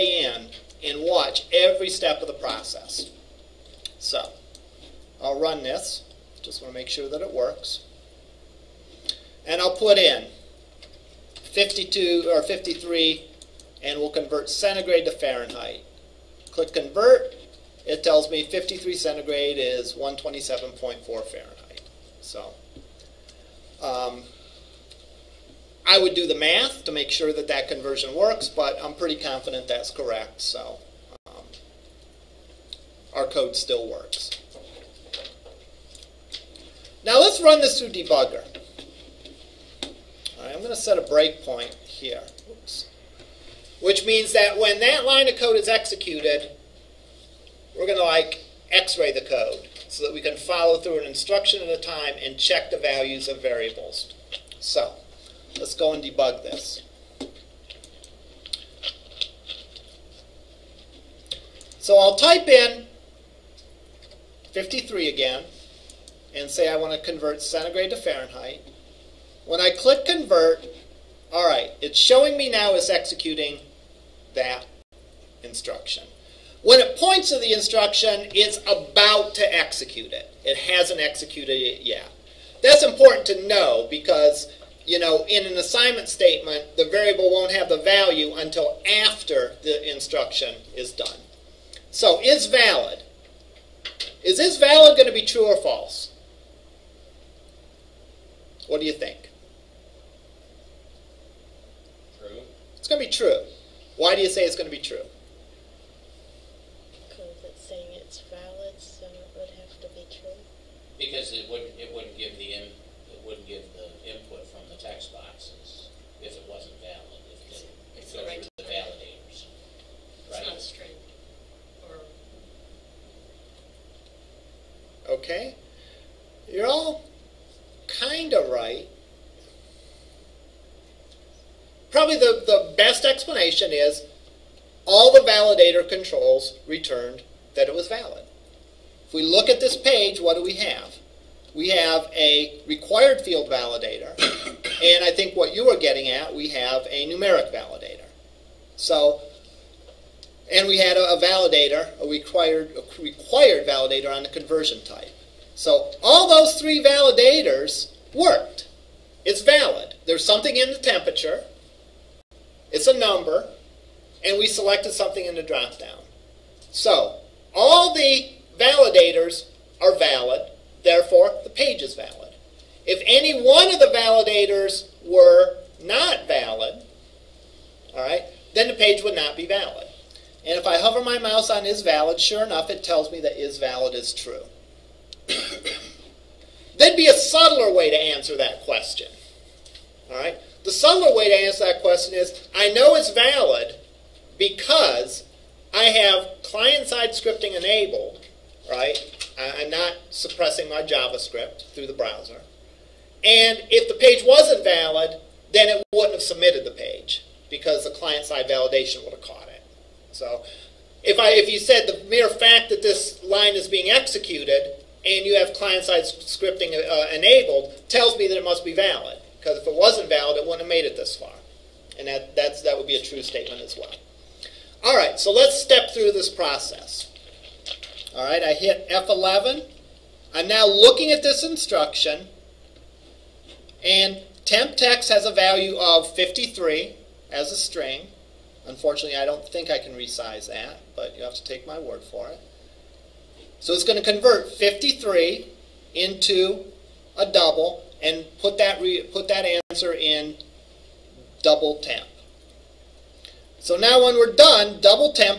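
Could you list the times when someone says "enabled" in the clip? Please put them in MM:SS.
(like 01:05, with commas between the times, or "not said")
03:17, 03:37.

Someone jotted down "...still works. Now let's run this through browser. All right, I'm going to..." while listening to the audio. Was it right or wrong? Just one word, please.
wrong.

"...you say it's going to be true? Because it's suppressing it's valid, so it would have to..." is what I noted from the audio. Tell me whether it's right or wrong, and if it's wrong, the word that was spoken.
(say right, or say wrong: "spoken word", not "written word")
wrong: "saying", not "suppressing".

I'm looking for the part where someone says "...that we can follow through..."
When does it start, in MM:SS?
00:50.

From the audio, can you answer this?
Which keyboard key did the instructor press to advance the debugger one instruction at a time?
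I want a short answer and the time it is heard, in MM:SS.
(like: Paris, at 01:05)
F11, at 03:48.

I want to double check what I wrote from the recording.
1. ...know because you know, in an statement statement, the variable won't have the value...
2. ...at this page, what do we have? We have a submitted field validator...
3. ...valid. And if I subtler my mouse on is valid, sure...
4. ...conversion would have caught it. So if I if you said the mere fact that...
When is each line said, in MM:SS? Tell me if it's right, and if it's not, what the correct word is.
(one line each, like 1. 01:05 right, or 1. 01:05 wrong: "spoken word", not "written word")
1. 01:23 wrong: "assignment", not "statement"
2. 02:19 wrong: "required", not "submitted"
3. 02:59 wrong: "hover", not "subtler"
4. 03:28 wrong: "validation", not "conversion".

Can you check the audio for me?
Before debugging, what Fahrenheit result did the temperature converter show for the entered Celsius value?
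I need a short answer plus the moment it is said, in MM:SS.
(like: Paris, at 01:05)
127.4, at 00:19.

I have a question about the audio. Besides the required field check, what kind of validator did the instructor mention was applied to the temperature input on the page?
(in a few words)
numeric validator.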